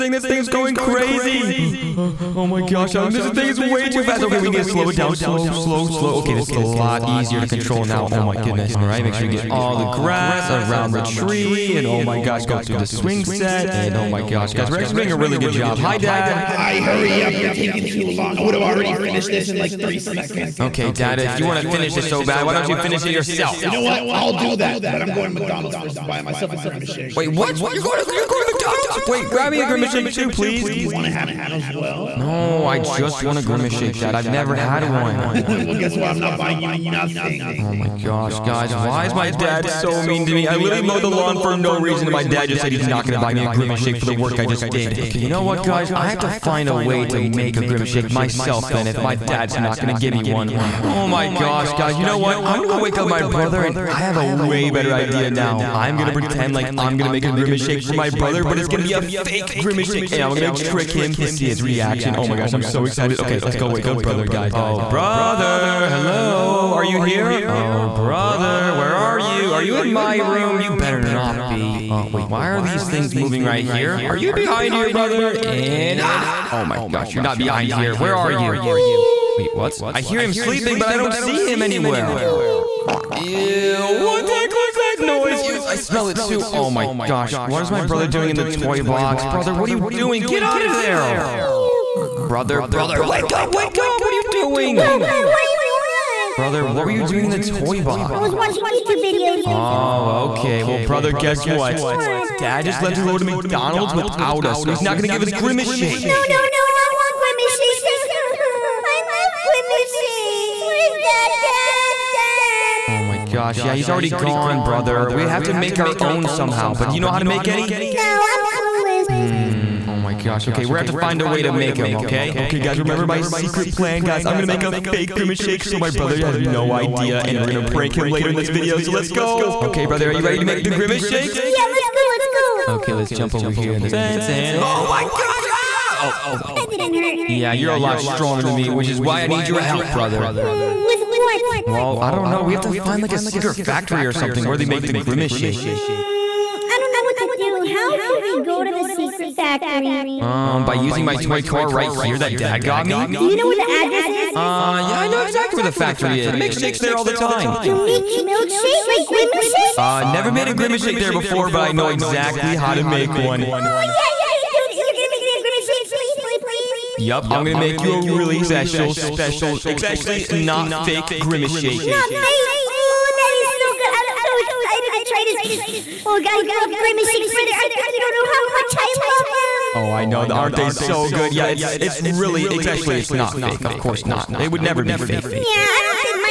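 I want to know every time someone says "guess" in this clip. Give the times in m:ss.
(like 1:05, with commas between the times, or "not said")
0:35, 1:41.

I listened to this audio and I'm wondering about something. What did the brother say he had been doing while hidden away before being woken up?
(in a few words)
watching YouTube videos.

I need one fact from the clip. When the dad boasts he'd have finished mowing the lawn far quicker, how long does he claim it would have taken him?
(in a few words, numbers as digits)
3 seconds.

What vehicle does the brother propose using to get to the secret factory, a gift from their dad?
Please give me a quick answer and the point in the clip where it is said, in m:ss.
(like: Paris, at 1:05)
toy car, at 2:31.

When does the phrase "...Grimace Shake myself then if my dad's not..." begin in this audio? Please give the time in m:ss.
0:47.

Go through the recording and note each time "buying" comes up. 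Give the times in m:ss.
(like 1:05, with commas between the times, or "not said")
0:26, 0:36.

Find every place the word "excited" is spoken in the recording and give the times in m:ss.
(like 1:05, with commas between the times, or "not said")
1:02, 2:54.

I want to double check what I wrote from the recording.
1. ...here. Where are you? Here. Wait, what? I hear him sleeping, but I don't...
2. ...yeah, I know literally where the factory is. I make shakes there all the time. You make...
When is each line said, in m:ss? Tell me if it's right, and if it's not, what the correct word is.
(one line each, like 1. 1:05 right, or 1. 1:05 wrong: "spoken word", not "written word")
1. 1:17 right
2. 2:34 wrong: "exactly", not "literally".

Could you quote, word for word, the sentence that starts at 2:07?
And we're going to prank him later in this video.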